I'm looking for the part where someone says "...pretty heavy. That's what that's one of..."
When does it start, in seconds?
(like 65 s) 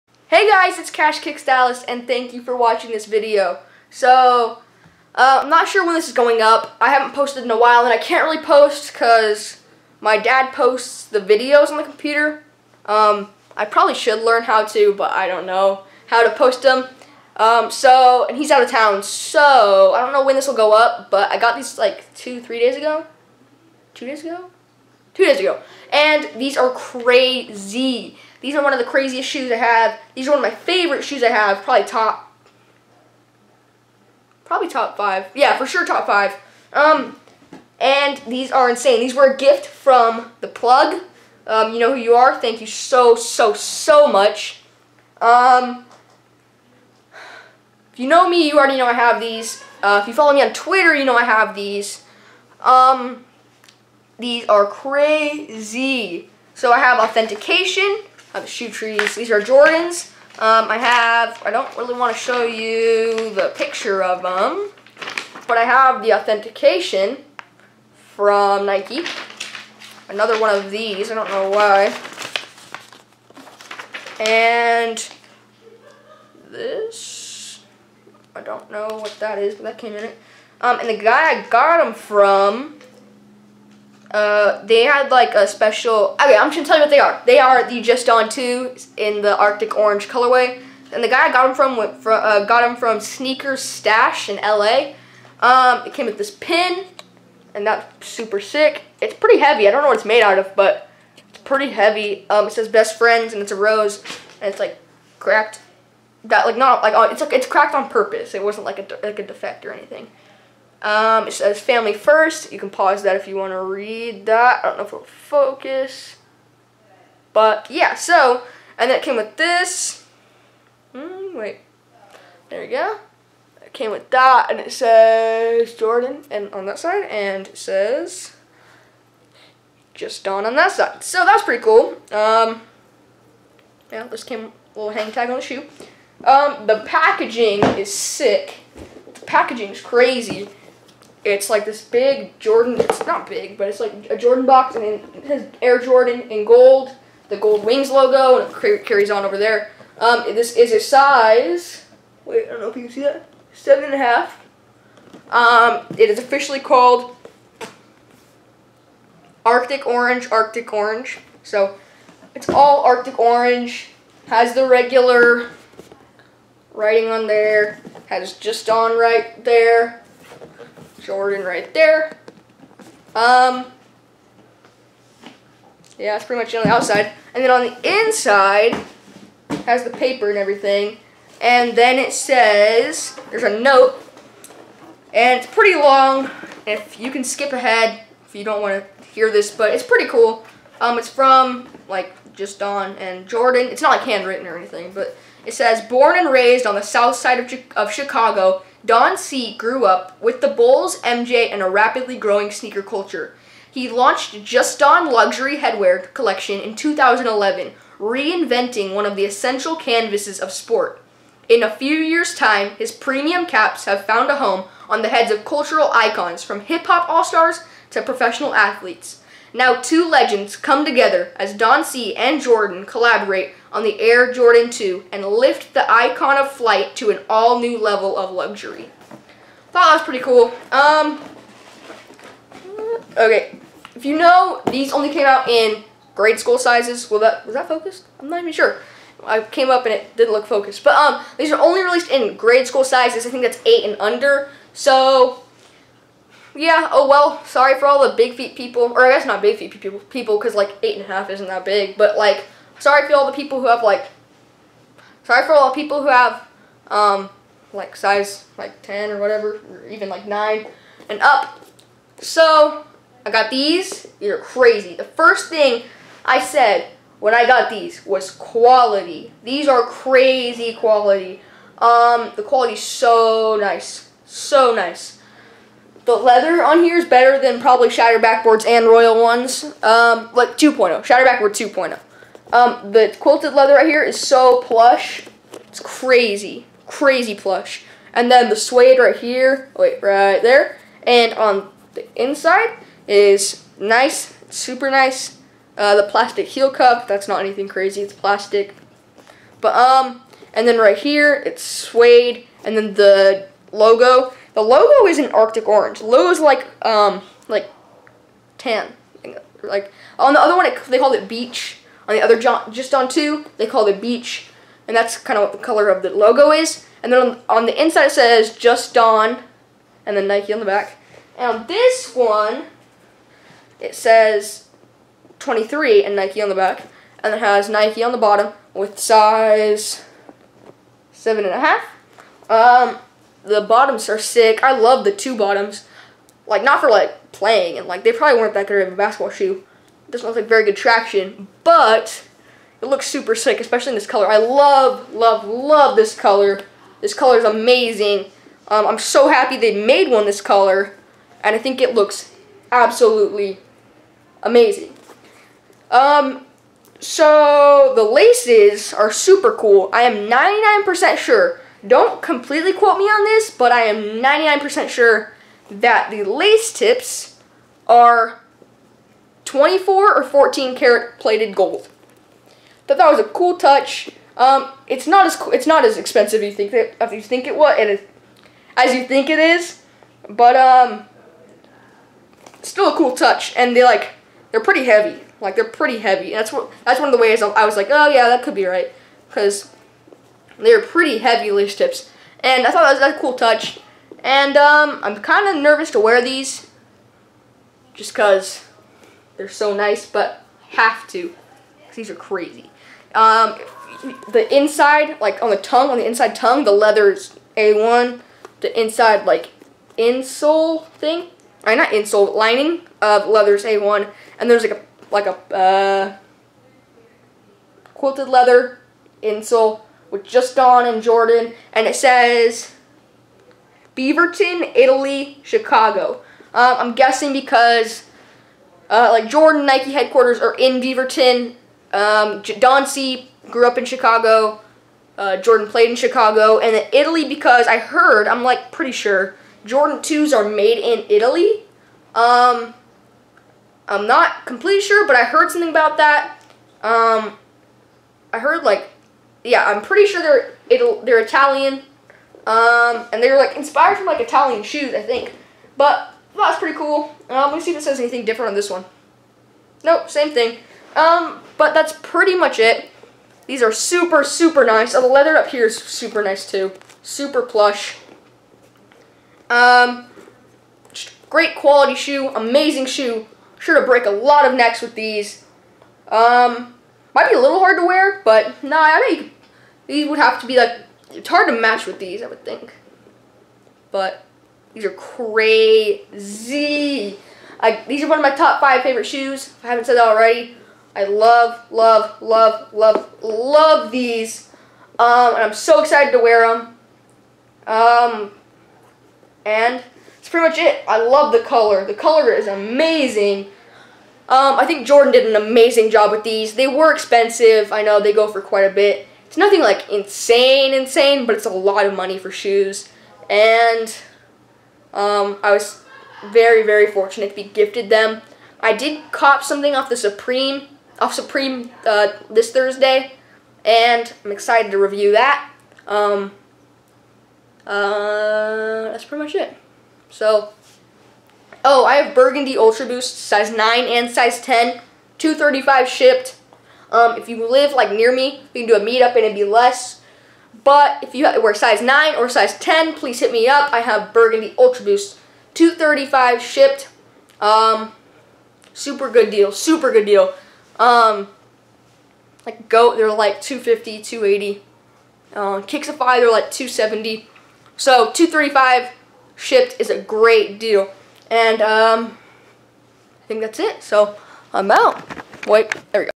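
385 s.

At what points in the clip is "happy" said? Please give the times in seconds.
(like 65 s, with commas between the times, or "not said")
349 s.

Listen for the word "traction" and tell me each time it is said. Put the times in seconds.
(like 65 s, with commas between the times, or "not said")
340 s.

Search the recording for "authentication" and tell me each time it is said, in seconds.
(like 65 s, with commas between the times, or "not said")
56 s, 66 s.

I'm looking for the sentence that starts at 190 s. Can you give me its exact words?
Um, it's from, like, just Don and Jordan.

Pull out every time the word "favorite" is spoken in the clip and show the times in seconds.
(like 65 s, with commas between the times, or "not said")
30 s, 488 s.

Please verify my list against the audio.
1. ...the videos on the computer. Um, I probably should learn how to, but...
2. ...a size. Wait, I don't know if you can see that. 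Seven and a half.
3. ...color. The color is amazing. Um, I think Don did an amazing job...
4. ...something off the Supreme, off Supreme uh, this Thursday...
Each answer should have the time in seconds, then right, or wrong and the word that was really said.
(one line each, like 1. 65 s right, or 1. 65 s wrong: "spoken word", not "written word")
1. 11 s right
2. 150 s right
3. 501 s wrong: "Jordan", not "Don"
4. 519 s right.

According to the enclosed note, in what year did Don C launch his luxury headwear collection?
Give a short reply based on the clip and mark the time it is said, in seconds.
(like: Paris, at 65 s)
2011, at 206 s.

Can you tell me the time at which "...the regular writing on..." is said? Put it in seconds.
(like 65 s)
164 s.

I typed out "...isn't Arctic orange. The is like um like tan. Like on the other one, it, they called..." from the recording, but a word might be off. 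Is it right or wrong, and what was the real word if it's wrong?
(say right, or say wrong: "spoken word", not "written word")
right.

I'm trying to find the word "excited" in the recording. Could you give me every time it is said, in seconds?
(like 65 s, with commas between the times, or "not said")
495 s, 524 s.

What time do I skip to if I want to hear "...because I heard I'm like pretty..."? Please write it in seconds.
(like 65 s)
437 s.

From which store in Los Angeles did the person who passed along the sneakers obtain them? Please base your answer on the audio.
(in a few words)
Sneaker Stash.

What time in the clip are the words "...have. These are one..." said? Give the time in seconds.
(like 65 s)
29 s.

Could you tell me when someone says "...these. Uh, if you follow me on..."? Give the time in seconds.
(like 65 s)
49 s.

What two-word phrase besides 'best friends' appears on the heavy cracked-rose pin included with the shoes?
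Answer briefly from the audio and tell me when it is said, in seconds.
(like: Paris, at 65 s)
Family first, at 111 s.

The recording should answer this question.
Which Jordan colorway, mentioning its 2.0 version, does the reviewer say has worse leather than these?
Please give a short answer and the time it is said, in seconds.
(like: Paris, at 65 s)
Shatter Backboard, at 277 s.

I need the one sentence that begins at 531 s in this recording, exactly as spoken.
Oh, I have Burgundy Ultra Boost, size 9 and size 10, 235 shipped.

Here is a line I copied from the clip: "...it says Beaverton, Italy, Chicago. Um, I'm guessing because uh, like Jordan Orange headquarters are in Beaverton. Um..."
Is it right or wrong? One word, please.
wrong.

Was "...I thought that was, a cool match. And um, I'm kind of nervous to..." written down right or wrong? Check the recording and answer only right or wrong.
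wrong.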